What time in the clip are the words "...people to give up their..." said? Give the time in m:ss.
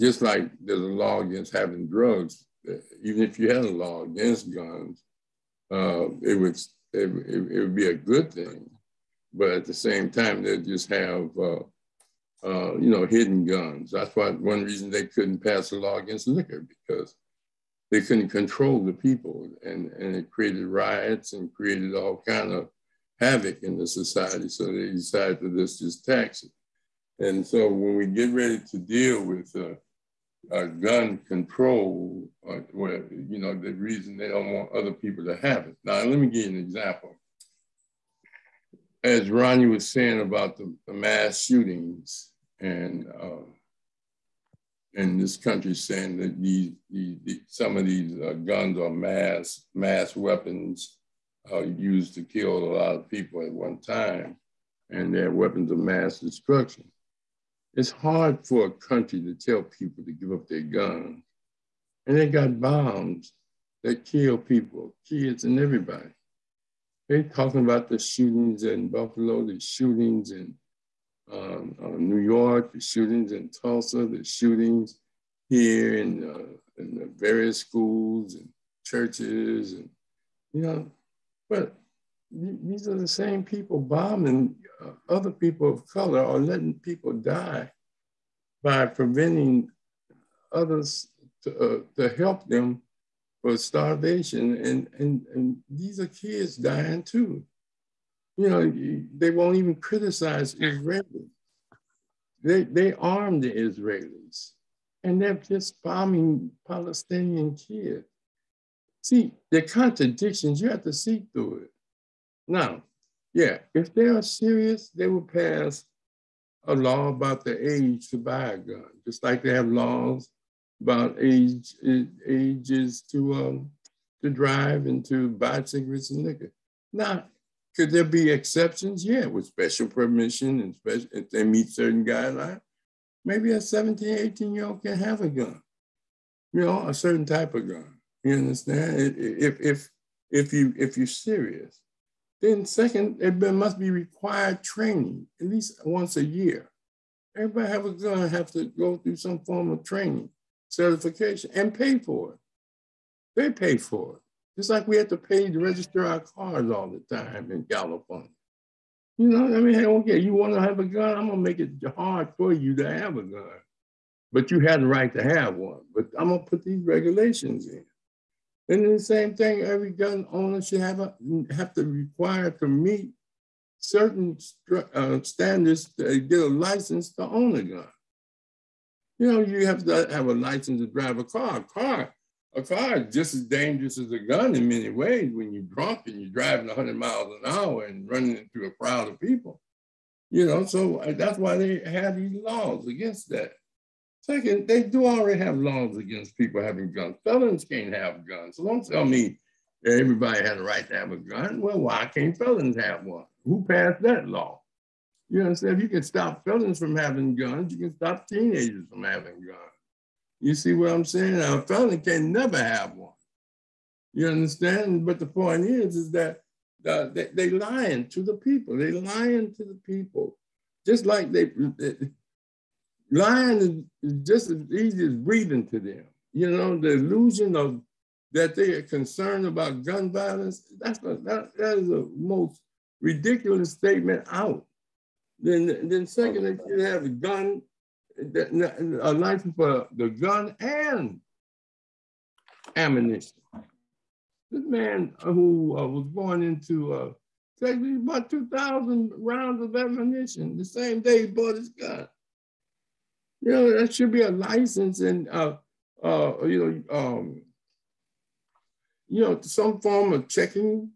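0:59.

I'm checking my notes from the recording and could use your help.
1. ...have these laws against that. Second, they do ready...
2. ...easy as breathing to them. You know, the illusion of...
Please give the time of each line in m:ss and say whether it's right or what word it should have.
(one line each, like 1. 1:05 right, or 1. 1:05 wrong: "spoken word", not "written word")
1. 3:11 wrong: "already", not "ready"
2. 3:44 right.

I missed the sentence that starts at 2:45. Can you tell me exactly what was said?
But I'm gonna put these regulations in.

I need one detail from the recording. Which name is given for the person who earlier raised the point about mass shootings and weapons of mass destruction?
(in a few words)
Ronnie.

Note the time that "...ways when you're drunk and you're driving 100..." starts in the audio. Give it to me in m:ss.
3:04.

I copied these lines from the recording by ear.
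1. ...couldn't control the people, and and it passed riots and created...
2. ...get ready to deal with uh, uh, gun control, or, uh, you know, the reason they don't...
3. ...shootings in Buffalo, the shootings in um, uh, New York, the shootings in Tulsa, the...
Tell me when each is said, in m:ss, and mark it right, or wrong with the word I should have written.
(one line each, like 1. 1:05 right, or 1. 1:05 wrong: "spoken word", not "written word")
1. 0:18 wrong: "created", not "passed"
2. 0:28 right
3. 1:07 right.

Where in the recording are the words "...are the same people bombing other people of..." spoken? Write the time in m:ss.
1:22.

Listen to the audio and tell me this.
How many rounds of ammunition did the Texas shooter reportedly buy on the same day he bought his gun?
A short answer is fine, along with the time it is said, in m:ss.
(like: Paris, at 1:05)
2,000, at 4:08.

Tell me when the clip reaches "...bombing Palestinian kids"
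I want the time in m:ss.
1:45.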